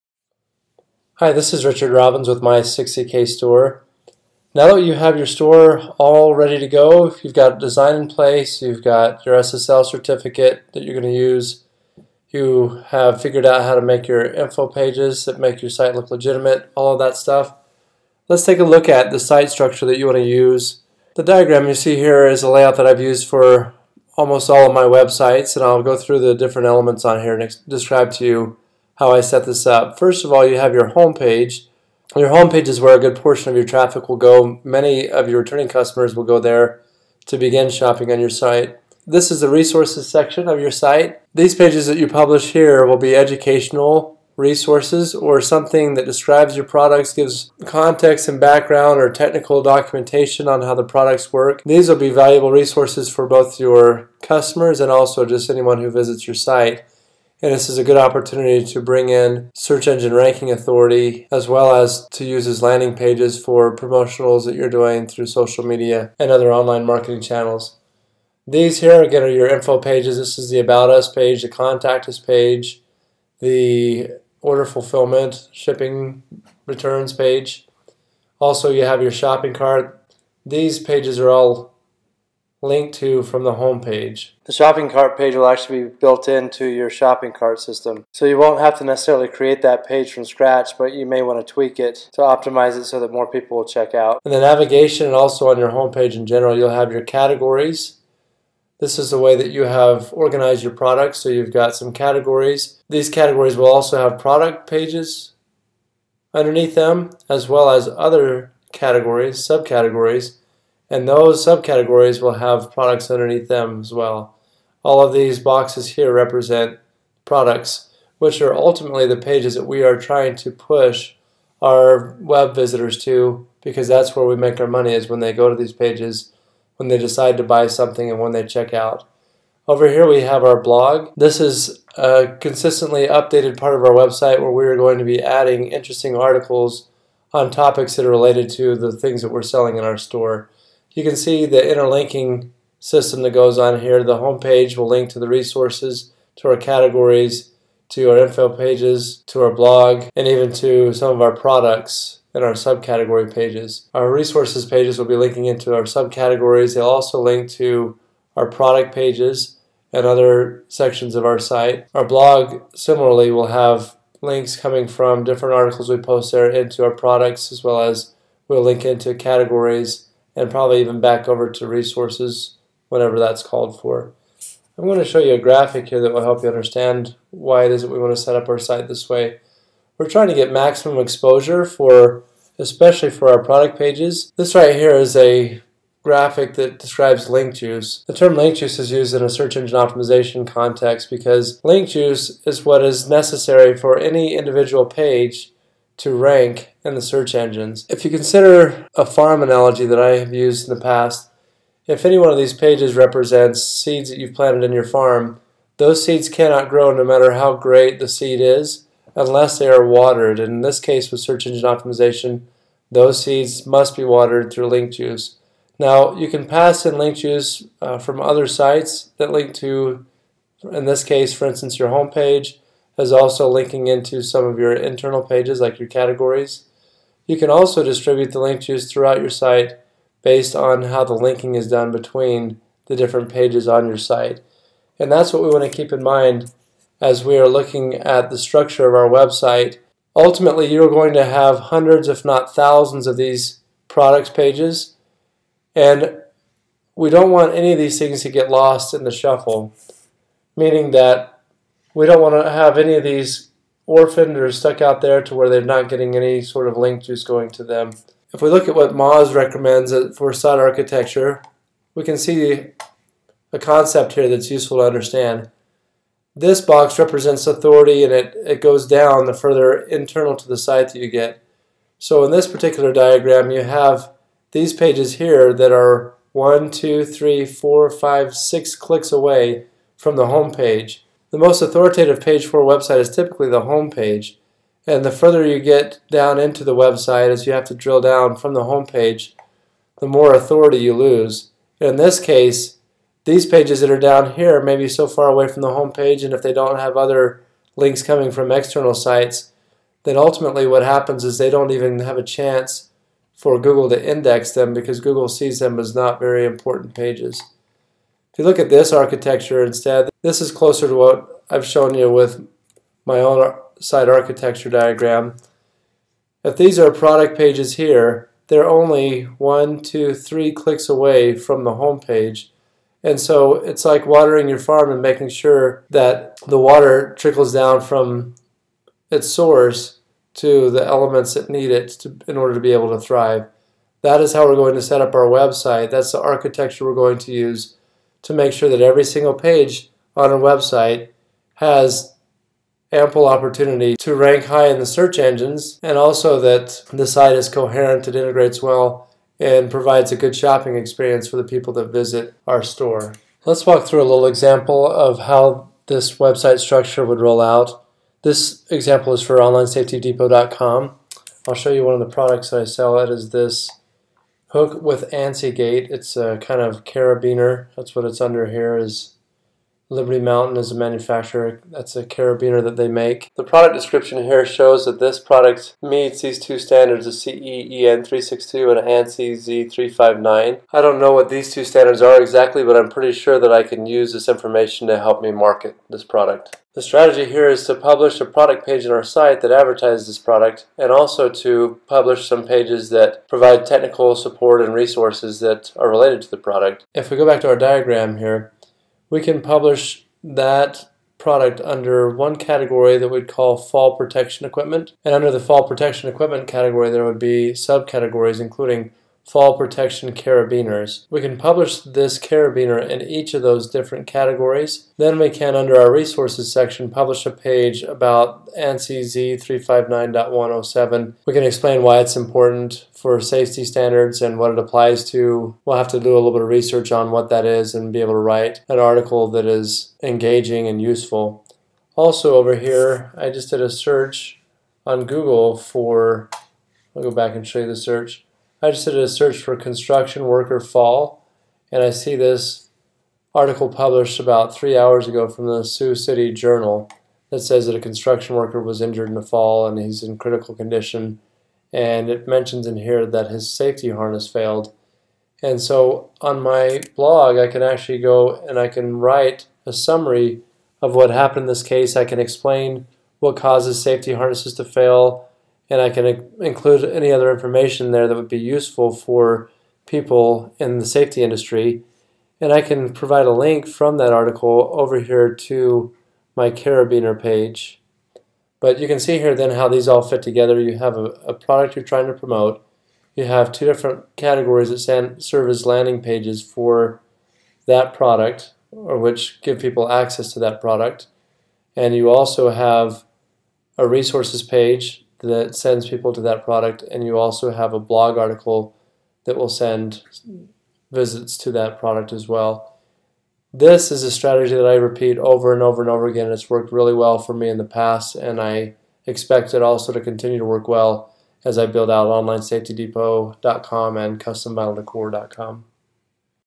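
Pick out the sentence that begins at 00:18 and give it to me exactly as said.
Let's take a look at the site structure that you want to use.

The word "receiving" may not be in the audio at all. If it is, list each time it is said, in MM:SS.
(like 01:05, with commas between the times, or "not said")
not said.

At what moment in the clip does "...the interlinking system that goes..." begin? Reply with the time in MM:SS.
02:21.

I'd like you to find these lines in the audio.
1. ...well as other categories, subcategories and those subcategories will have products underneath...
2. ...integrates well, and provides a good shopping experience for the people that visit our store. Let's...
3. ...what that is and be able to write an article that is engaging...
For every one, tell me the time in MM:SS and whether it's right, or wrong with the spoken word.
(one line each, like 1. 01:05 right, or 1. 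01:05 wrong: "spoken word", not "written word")
1. 01:47 right
2. 05:48 right
3. 07:07 right.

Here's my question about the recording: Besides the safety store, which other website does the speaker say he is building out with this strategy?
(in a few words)
CustomBattleDecor.com.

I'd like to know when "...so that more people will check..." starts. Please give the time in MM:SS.
01:32.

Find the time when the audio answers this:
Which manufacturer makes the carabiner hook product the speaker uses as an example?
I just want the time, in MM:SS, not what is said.
06:09.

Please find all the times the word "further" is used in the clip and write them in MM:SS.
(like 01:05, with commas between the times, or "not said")
04:29, 04:45.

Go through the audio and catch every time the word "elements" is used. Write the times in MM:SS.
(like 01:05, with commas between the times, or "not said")
00:26, 05:30.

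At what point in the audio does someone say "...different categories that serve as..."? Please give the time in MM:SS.
08:03.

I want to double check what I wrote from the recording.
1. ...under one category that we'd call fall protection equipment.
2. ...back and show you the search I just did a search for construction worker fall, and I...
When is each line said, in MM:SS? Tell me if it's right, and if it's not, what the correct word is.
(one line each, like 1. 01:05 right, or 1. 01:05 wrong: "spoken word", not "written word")
1. 06:41 right
2. 07:17 right.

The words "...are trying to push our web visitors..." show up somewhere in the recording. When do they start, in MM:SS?
01:59.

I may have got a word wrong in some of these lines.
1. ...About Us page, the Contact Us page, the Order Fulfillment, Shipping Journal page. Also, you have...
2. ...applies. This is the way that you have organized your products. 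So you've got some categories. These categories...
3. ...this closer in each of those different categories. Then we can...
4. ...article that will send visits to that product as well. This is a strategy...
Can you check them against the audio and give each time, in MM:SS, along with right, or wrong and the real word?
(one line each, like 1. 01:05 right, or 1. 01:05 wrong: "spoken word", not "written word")
1. 01:10 wrong: "Returns", not "Journal"
2. 01:37 wrong: "categories", not "applies"
3. 06:51 wrong: "carabiner", not "closer"
4. 08:18 right.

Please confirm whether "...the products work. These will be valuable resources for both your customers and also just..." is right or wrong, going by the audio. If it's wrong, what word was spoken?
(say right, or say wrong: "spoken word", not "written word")
right.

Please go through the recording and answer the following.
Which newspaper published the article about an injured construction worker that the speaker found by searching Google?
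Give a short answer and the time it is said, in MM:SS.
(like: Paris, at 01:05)
Sioux City Journal, at 07:25.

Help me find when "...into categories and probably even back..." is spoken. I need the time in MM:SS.
02:48.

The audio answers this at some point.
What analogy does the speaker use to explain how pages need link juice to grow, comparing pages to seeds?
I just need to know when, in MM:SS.
03:19.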